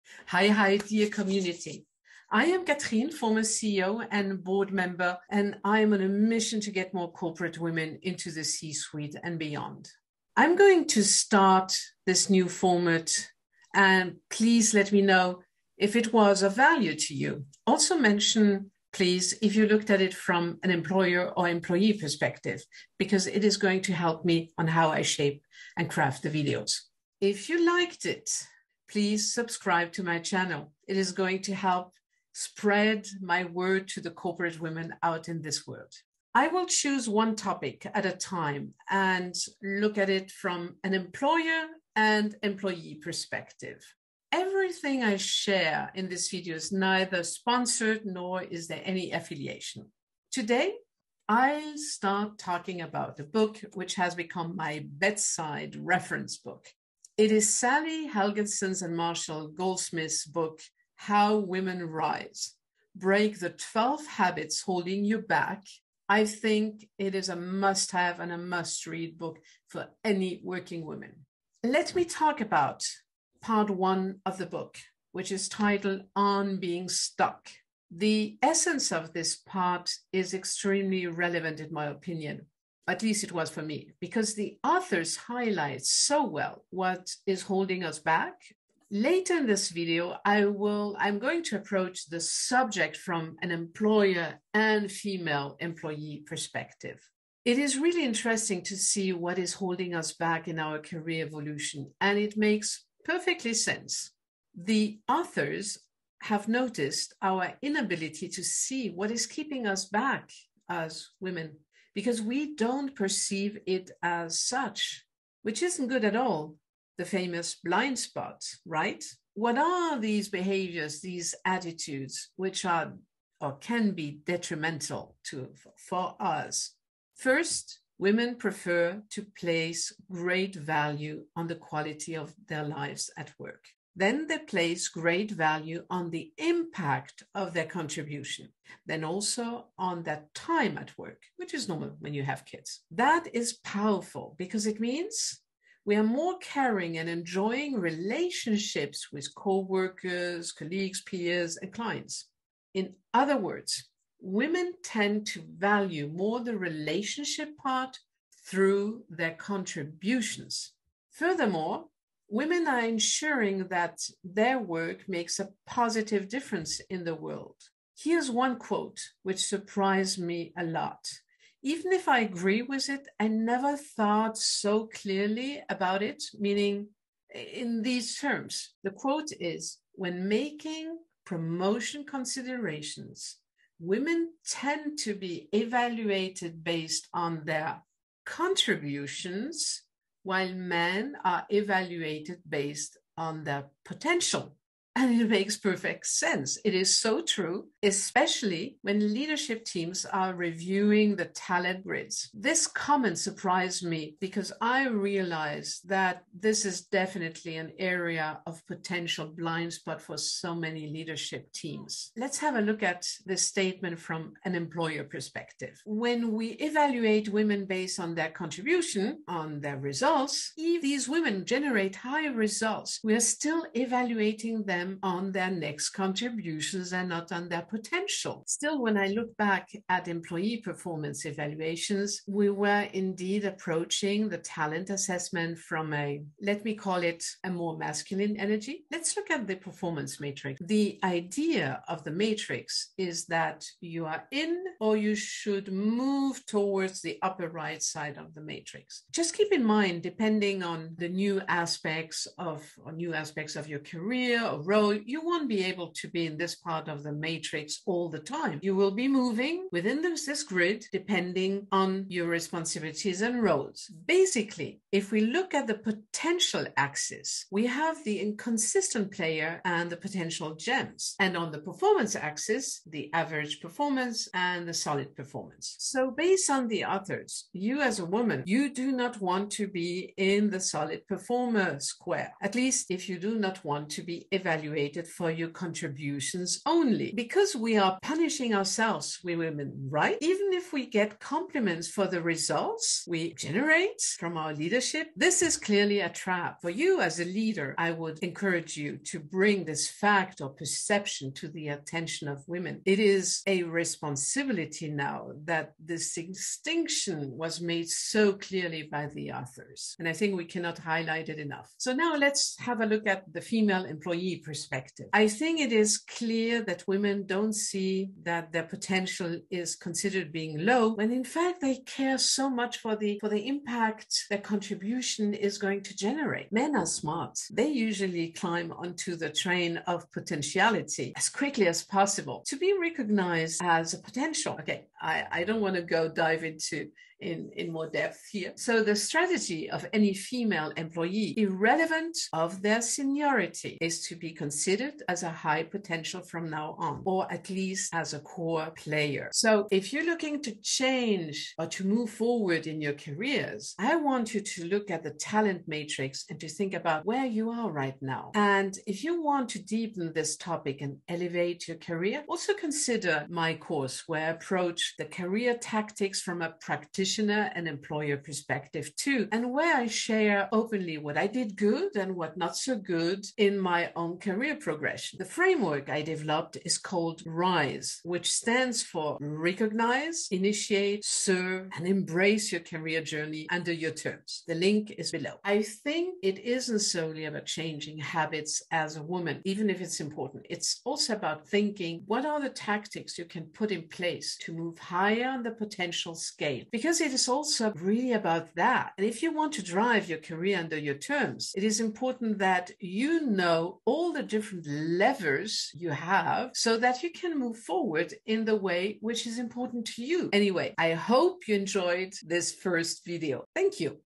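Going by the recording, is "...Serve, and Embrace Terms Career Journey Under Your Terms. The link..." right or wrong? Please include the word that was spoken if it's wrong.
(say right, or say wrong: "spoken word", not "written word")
wrong: "Your", not "Terms".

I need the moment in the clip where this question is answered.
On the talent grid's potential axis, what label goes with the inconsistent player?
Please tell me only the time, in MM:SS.
04:30.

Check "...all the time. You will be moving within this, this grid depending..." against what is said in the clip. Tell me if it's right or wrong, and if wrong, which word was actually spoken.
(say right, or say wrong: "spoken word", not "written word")
right.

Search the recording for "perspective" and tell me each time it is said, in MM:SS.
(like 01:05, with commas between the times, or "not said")
00:21, 00:43, 01:36, 03:35, 05:14, 06:08.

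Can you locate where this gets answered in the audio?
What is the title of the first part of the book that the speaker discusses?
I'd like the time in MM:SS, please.
01:16.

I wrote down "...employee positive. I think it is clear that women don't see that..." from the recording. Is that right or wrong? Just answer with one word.
wrong.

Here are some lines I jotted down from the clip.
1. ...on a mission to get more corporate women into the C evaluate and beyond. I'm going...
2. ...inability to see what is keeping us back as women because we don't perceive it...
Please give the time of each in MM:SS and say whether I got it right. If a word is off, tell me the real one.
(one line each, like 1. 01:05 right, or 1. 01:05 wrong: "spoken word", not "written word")
1. 00:05 wrong: "suite", not "evaluate"
2. 01:47 right.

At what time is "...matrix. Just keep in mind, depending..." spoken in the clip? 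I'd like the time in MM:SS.
04:08.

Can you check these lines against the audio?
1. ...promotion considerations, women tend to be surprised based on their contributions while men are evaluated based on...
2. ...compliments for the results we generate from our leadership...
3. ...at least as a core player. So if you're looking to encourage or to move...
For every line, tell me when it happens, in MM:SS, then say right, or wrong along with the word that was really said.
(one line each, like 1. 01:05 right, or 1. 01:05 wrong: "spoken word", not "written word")
1. 03:01 wrong: "evaluated", not "surprised"
2. 04:51 right
3. 05:47 wrong: "change", not "encourage".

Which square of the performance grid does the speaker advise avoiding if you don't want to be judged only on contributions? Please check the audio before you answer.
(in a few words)
solid performer.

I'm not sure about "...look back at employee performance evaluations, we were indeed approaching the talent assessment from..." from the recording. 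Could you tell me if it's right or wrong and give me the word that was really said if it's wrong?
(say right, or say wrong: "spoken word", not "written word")
right.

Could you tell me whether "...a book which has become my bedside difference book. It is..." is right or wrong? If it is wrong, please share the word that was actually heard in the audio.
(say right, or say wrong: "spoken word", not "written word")
wrong: "reference", not "difference".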